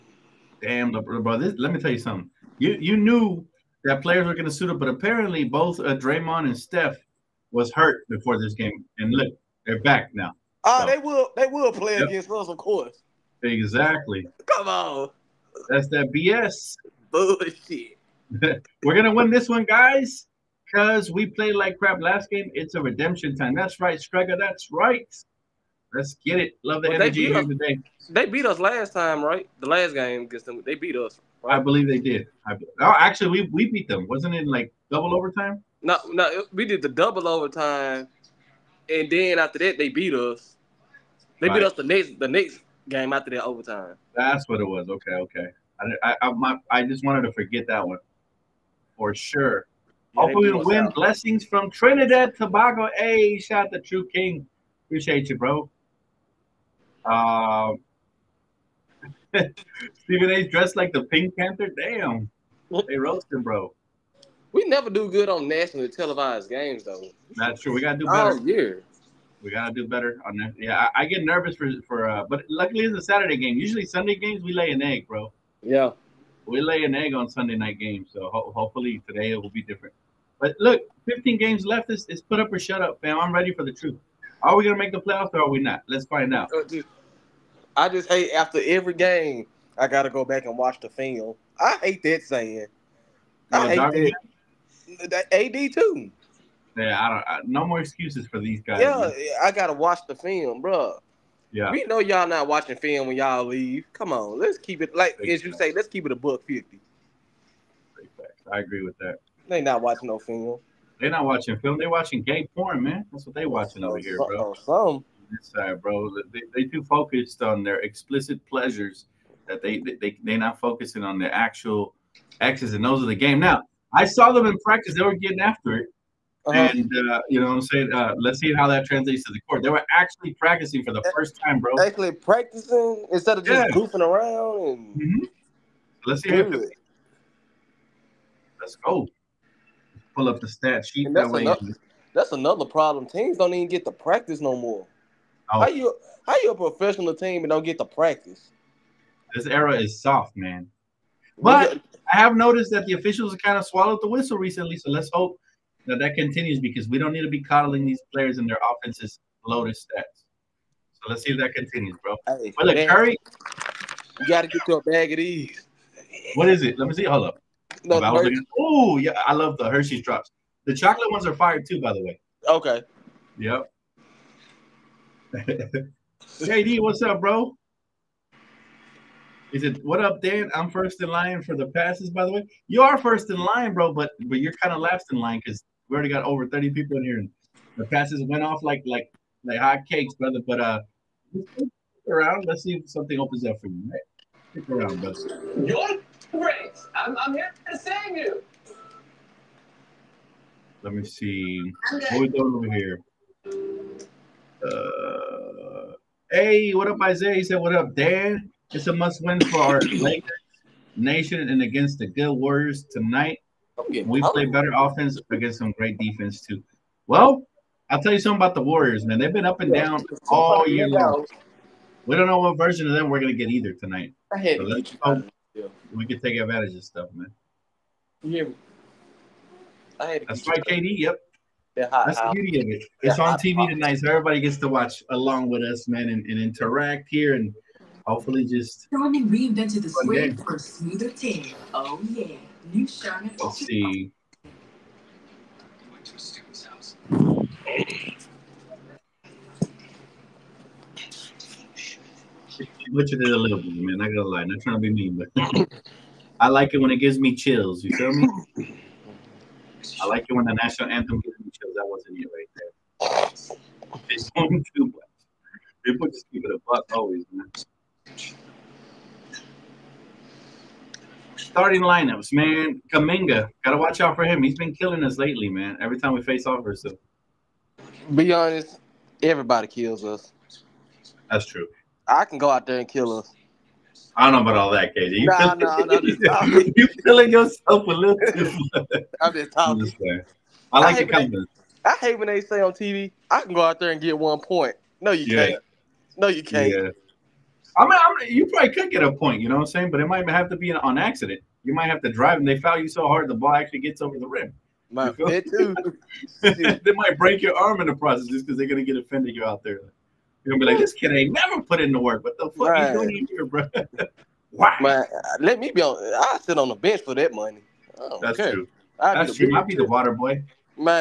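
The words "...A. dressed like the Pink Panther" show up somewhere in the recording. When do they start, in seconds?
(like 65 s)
60 s.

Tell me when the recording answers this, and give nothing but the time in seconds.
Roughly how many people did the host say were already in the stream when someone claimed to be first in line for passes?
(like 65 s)
186 s.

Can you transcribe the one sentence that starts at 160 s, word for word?
So let's see if that continues, bro.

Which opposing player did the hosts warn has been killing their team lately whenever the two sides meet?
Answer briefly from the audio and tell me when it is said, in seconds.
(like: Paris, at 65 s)
Kuminga, at 272 s.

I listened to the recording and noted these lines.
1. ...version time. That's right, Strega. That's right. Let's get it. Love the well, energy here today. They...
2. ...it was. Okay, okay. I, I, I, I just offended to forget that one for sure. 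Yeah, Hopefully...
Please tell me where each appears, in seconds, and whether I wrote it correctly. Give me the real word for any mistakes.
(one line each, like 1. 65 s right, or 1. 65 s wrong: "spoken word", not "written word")
1. 22 s wrong: "redemption", not "version"
2. 44 s wrong: "wanted", not "offended".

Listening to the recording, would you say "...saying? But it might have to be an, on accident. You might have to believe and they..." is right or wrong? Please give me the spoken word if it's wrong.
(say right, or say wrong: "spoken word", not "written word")
wrong: "drive", not "believe".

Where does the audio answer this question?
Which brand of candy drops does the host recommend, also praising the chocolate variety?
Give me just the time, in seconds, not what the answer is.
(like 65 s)
169 s.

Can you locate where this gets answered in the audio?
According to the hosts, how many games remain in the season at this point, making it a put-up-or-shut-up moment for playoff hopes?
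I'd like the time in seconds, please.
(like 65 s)
81 s.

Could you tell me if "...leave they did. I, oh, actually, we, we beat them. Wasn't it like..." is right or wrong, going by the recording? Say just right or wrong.
wrong.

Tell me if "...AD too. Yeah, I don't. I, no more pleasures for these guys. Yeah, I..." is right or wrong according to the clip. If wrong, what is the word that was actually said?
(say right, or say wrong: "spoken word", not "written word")
wrong: "excuses", not "pleasures".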